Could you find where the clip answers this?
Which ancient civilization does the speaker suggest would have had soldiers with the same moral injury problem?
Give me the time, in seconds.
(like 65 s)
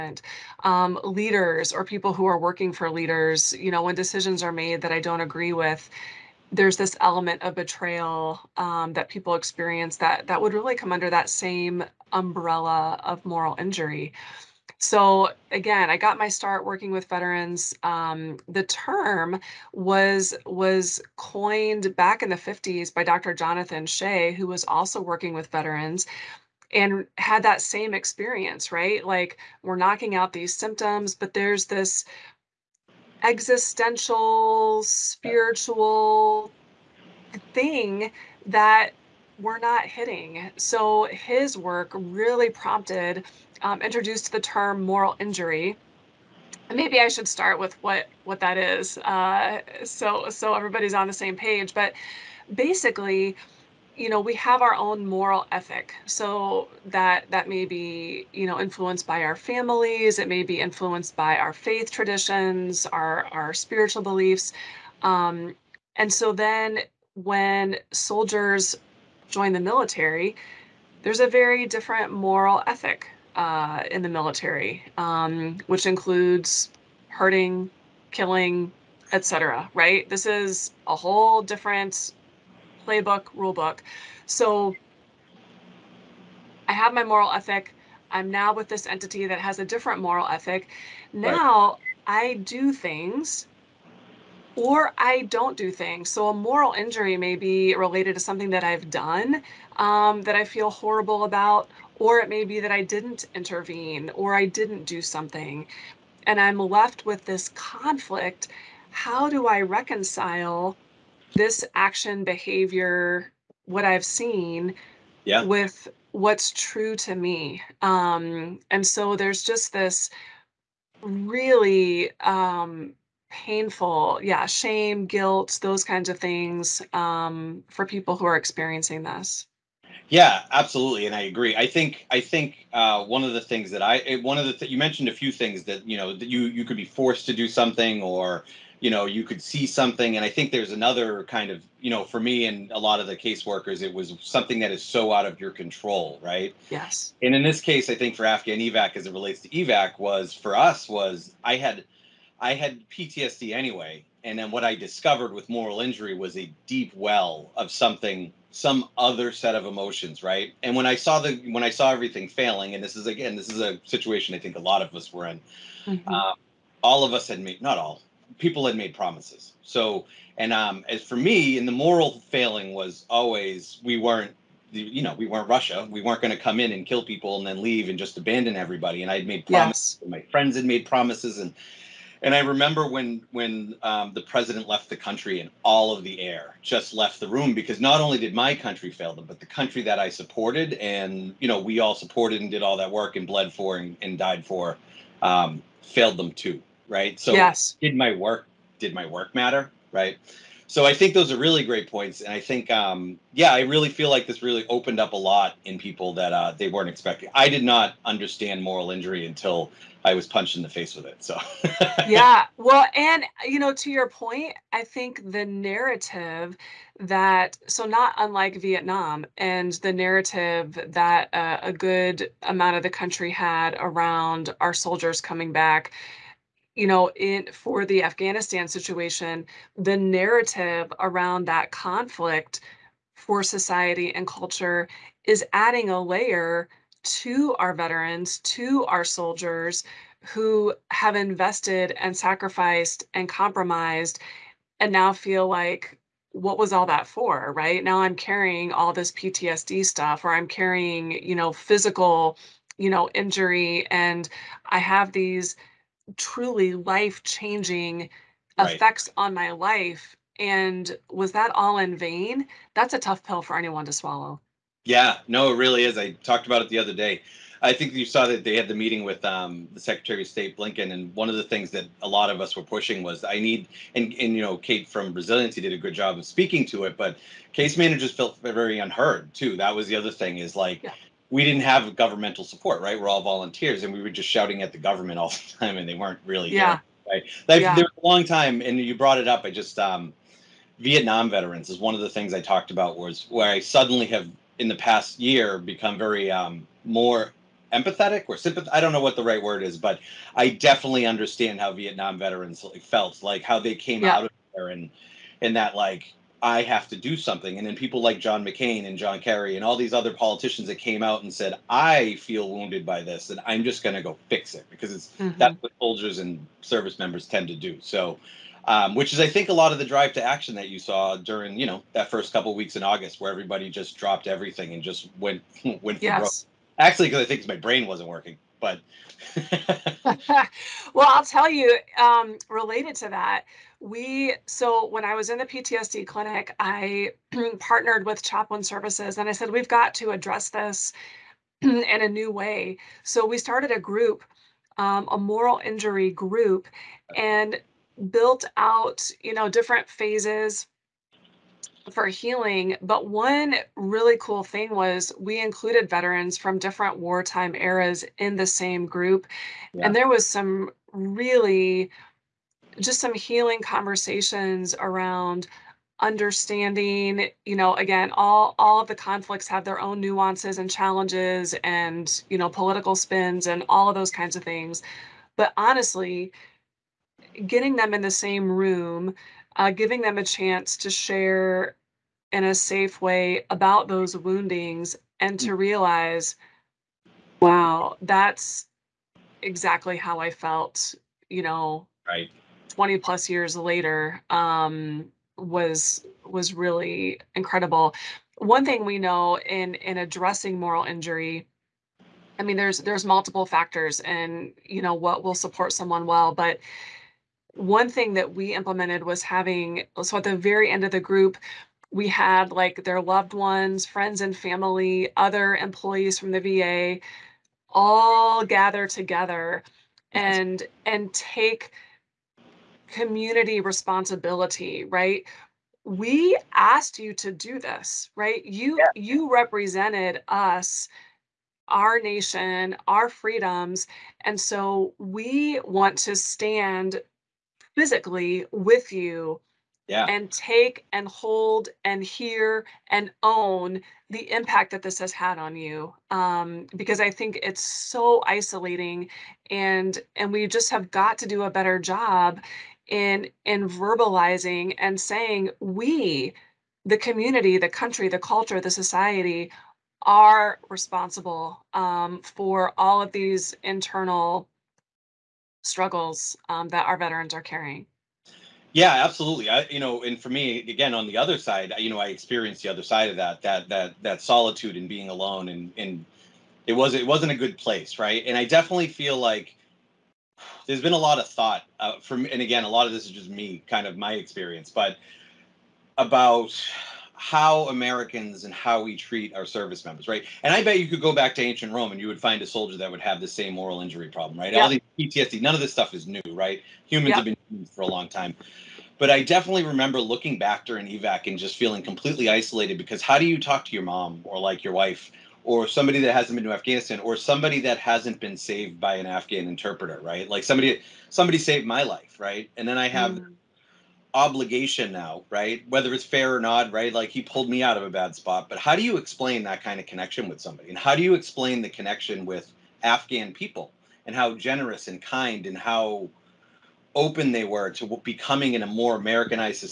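491 s.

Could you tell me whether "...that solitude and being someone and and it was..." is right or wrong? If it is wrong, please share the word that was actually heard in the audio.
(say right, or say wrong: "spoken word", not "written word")
wrong: "alone", not "someone".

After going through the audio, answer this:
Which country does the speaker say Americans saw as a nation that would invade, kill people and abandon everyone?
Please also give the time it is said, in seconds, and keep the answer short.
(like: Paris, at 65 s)
Russia, at 175 s.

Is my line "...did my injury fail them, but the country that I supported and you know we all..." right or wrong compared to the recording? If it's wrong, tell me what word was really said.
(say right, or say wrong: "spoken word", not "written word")
wrong: "country", not "injury".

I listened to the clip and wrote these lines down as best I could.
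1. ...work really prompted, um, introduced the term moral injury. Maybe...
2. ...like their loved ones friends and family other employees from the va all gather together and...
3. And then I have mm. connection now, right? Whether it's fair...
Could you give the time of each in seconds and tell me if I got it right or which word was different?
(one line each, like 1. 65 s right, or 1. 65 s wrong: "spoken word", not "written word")
1. 41 s right
2. 412 s right
3. 512 s wrong: "obligation", not "connection".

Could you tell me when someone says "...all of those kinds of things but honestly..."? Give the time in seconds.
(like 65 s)
373 s.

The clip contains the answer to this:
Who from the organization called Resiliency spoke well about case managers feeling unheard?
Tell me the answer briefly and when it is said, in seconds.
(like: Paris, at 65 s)
Kate, at 274 s.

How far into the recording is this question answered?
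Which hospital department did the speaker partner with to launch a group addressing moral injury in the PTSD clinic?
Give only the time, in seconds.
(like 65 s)
338 s.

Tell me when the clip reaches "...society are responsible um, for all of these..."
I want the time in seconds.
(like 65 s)
458 s.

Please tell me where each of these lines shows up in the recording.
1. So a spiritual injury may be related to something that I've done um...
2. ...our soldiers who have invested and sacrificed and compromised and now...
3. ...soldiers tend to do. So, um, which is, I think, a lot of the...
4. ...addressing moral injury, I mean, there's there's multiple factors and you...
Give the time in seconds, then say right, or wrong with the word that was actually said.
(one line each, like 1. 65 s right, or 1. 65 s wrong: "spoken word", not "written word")
1. 96 s wrong: "moral", not "spiritual"
2. 238 s right
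3. 316 s wrong: "members", not "soldiers"
4. 399 s right.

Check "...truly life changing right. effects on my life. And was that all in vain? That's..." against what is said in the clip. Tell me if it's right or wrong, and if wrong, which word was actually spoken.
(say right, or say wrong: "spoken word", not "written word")
right.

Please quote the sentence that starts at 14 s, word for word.
So again, I got my start working with veterans.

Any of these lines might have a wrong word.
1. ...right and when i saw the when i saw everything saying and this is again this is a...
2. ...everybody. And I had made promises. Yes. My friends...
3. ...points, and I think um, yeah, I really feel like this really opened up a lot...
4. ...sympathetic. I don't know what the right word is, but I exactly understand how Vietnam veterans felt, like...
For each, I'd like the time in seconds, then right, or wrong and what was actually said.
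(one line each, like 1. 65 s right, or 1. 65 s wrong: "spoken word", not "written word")
1. 160 s wrong: "failing", not "saying"
2. 178 s right
3. 201 s right
4. 298 s wrong: "definitely", not "exactly".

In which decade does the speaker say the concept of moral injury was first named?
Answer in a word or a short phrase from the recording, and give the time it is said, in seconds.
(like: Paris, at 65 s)
the 50s, at 22 s.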